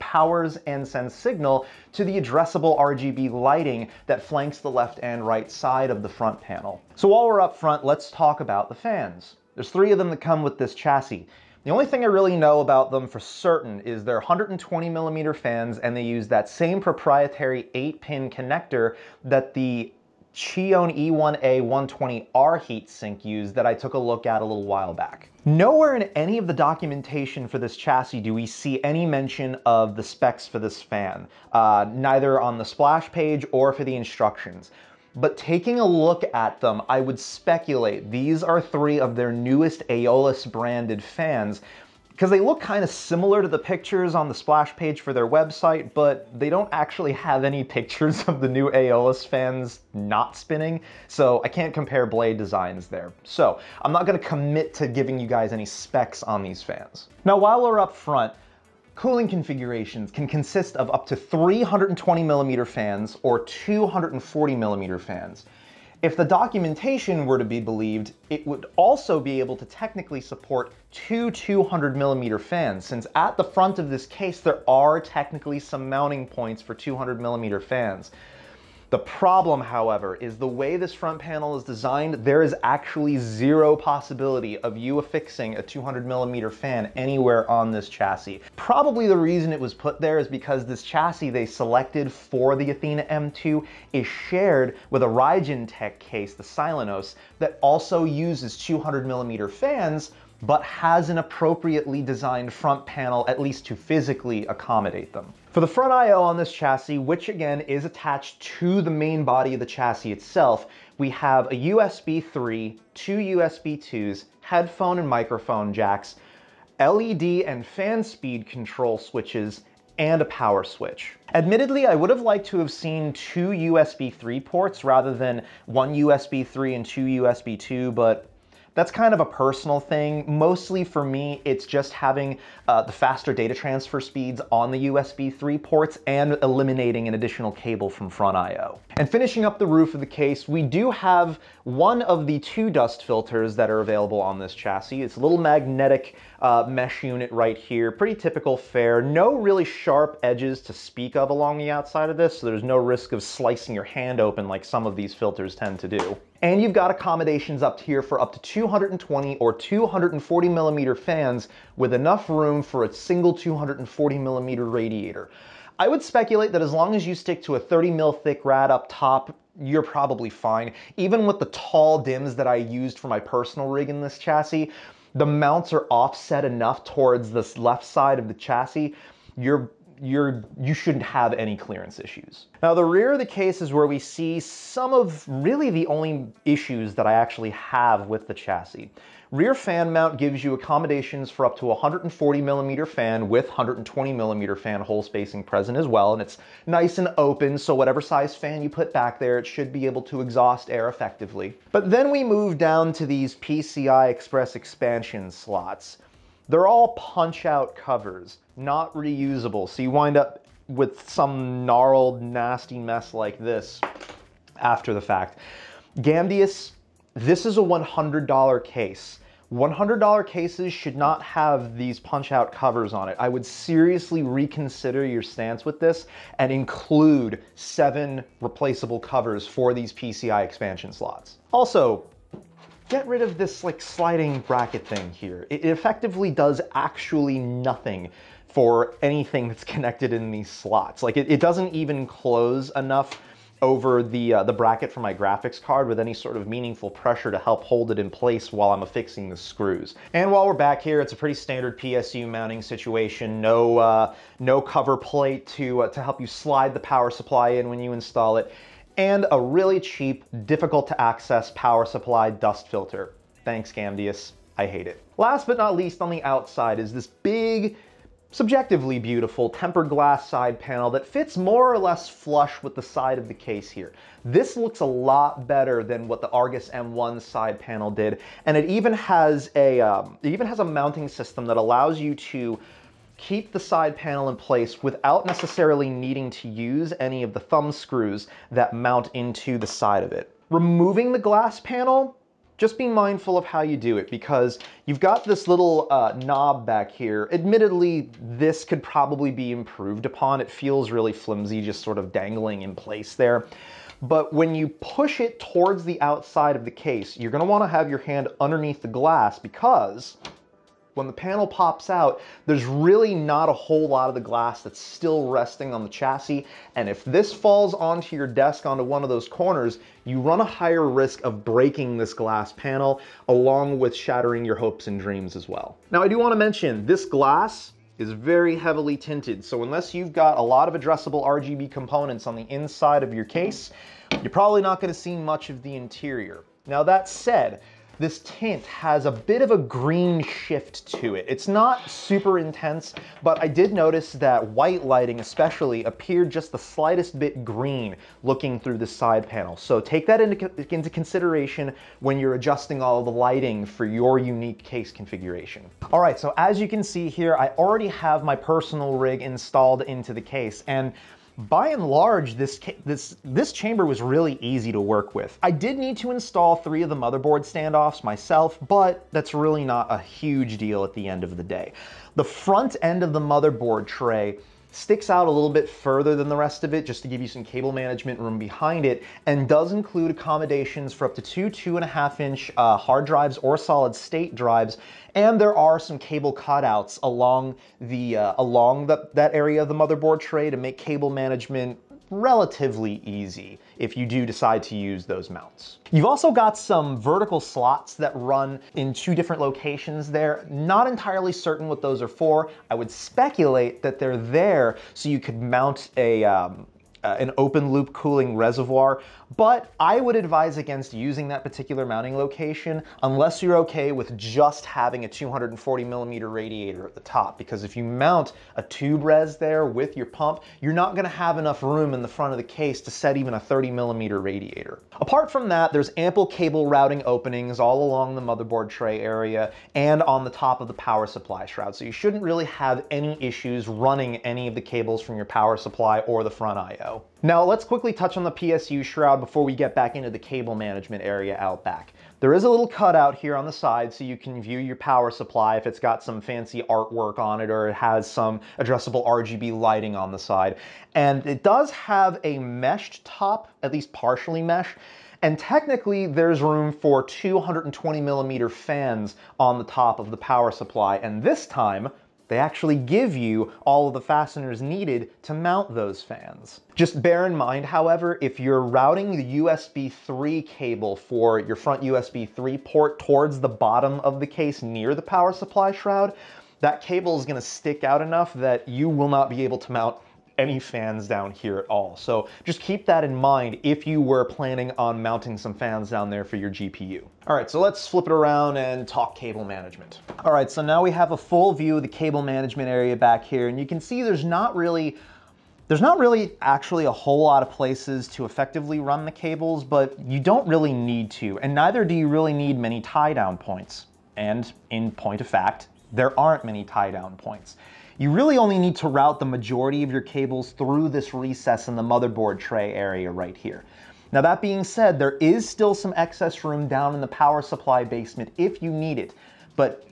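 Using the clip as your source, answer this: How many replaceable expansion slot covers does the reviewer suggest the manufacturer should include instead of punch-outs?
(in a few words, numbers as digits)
7.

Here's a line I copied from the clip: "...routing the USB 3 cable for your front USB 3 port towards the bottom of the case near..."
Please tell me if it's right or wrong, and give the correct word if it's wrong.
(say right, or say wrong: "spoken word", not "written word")
right.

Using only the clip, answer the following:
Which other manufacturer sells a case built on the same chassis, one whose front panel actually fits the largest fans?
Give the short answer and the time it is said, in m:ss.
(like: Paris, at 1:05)
Raijintek, at 1:35.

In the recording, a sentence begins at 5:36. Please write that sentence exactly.
Now that said, this tint has a bit of a green shift to it.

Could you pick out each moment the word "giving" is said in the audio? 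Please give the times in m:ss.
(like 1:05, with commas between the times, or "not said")
0:54.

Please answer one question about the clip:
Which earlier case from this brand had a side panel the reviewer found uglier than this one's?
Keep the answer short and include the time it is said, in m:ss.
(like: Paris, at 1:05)
Argus M1, at 4:36.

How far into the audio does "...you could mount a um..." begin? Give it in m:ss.
6:45.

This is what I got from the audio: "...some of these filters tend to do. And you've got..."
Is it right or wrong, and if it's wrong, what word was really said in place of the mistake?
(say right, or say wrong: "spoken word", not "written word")
right.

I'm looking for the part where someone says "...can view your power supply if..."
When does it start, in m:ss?
7:24.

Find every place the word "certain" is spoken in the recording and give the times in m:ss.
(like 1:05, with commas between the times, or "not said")
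0:13, 6:41.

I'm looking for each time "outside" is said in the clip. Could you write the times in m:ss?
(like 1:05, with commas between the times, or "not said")
2:31, 4:26, 5:06.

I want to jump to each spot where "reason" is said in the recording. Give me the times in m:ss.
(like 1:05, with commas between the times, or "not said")
1:29.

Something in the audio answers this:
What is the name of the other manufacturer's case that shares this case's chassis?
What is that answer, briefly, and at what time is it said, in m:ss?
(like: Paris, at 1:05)
Silenos, at 1:36.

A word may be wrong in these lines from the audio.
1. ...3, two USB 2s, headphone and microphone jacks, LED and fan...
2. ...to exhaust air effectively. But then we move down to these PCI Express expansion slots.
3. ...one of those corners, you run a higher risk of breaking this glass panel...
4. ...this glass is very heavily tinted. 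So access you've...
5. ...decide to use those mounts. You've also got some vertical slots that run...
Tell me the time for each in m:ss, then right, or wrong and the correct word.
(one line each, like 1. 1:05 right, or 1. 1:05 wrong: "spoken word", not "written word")
1. 1:52 right
2. 3:20 right
3. 5:18 right
4. 5:26 wrong: "unless", not "access"
5. 6:34 right.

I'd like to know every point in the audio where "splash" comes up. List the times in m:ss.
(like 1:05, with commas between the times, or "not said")
0:32, 0:44.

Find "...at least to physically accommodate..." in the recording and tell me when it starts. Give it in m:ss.
1:43.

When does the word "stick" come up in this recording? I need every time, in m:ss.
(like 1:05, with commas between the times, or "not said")
2:47, 6:14, 7:57.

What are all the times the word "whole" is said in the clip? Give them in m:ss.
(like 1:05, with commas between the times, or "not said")
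5:13, 8:16.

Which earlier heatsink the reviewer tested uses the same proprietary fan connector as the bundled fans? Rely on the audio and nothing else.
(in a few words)
Chione E1A 120R.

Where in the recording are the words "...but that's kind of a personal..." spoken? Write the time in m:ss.
2:07.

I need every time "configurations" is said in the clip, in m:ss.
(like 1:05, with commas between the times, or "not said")
0:59, 5:54.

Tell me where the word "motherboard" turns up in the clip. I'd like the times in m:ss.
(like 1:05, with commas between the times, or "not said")
6:06, 6:13, 6:29, 7:08, 8:31.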